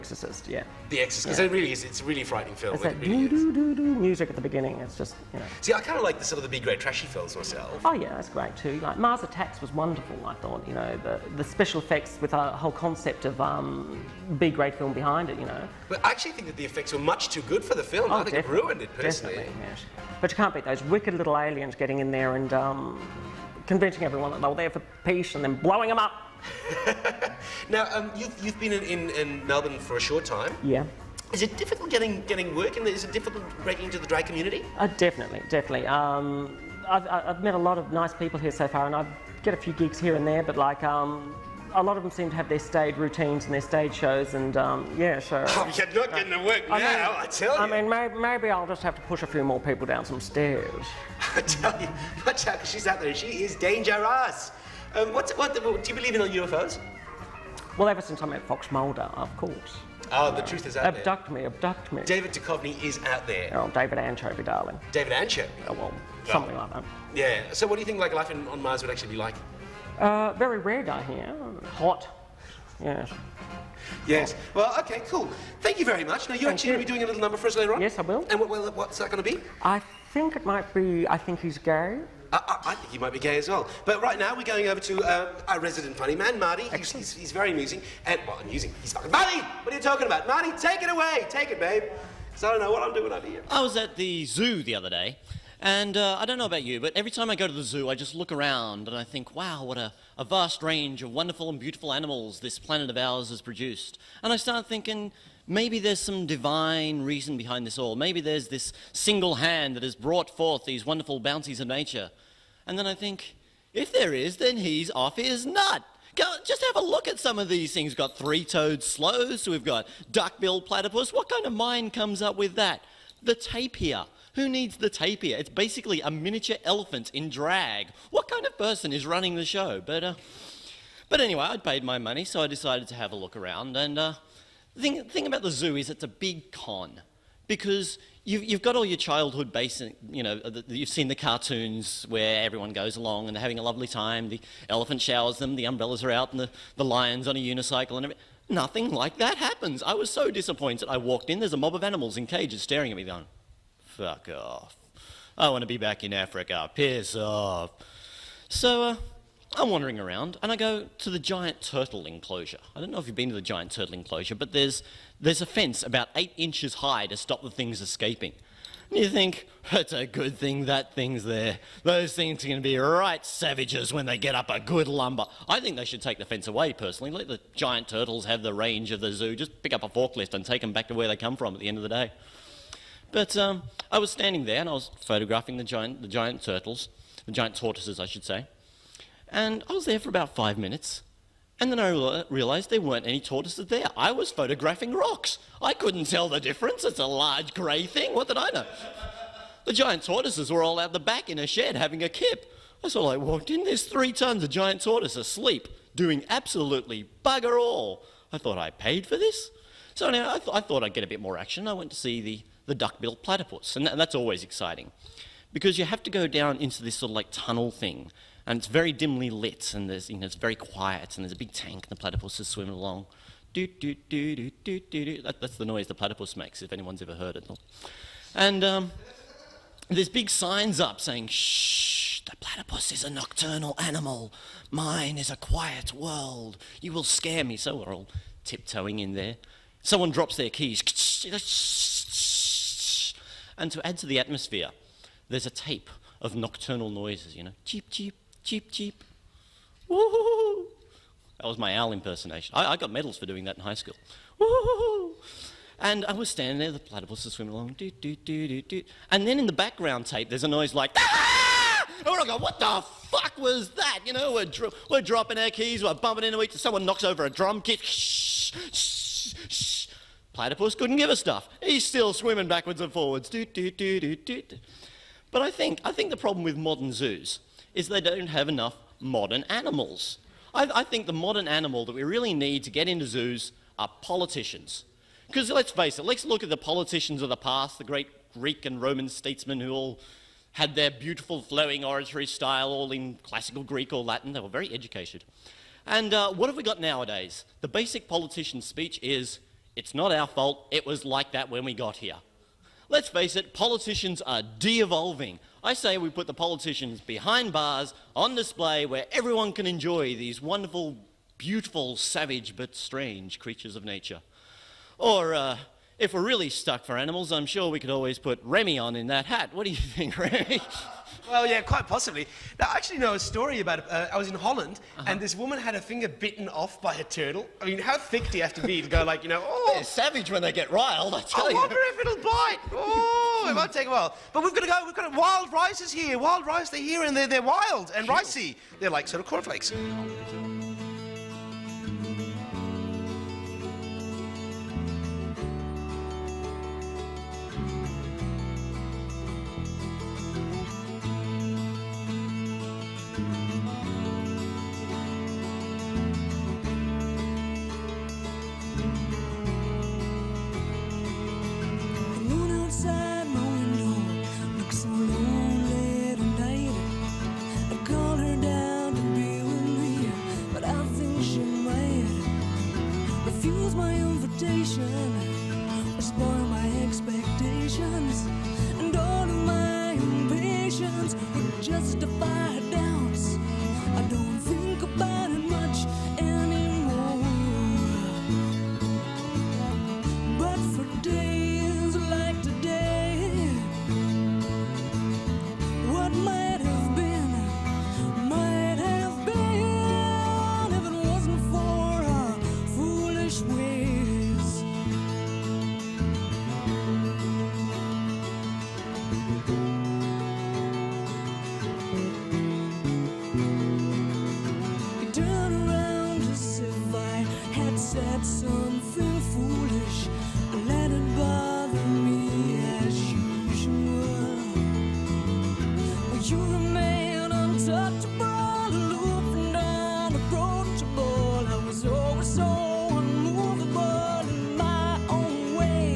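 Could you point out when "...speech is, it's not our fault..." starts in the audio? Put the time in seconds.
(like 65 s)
298 s.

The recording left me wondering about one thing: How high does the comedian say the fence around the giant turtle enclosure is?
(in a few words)
8 inches.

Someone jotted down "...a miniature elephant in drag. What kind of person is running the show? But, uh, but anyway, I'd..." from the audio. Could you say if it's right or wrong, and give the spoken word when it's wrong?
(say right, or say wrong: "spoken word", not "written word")
right.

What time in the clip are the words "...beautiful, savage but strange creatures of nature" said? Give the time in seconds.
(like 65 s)
311 s.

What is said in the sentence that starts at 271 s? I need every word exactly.
He's still swimming backwards and forwards.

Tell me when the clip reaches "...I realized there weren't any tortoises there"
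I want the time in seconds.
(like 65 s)
191 s.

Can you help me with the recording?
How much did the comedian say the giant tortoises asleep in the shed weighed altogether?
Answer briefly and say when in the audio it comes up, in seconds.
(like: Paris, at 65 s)
3 tons, at 203 s.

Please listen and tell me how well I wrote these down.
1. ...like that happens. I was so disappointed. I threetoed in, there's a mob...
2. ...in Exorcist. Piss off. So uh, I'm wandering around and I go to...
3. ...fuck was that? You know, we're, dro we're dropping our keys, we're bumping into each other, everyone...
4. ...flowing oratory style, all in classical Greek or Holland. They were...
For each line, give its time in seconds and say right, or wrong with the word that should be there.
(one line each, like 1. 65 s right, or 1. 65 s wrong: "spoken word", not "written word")
1. 148 s wrong: "walked", not "threetoed"
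2. 156 s wrong: "Africa", not "Exorcist"
3. 263 s wrong: "someone", not "everyone"
4. 291 s wrong: "Latin", not "Holland".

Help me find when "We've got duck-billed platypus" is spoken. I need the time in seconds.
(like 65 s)
119 s.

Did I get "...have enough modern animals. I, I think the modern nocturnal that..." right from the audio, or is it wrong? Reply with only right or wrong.
wrong.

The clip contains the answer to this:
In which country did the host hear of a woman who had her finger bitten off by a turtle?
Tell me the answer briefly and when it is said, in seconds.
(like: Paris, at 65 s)
Holland, at 324 s.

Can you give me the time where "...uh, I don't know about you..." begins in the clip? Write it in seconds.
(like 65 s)
95 s.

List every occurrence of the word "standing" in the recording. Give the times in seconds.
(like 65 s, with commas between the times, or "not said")
184 s, 256 s.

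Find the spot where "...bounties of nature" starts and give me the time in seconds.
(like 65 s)
111 s.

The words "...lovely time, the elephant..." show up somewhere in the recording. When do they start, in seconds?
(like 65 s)
143 s.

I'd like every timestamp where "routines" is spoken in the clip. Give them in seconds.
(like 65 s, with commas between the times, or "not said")
42 s.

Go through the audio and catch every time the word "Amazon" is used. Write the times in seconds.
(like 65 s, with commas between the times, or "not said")
not said.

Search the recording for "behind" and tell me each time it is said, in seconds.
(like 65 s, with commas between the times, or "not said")
14 s, 107 s, 307 s.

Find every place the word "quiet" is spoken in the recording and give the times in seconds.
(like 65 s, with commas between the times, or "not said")
220 s, 235 s.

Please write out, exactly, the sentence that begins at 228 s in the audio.
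And um, there's big signs up saying, shh, the platypus is a nocturnal animal.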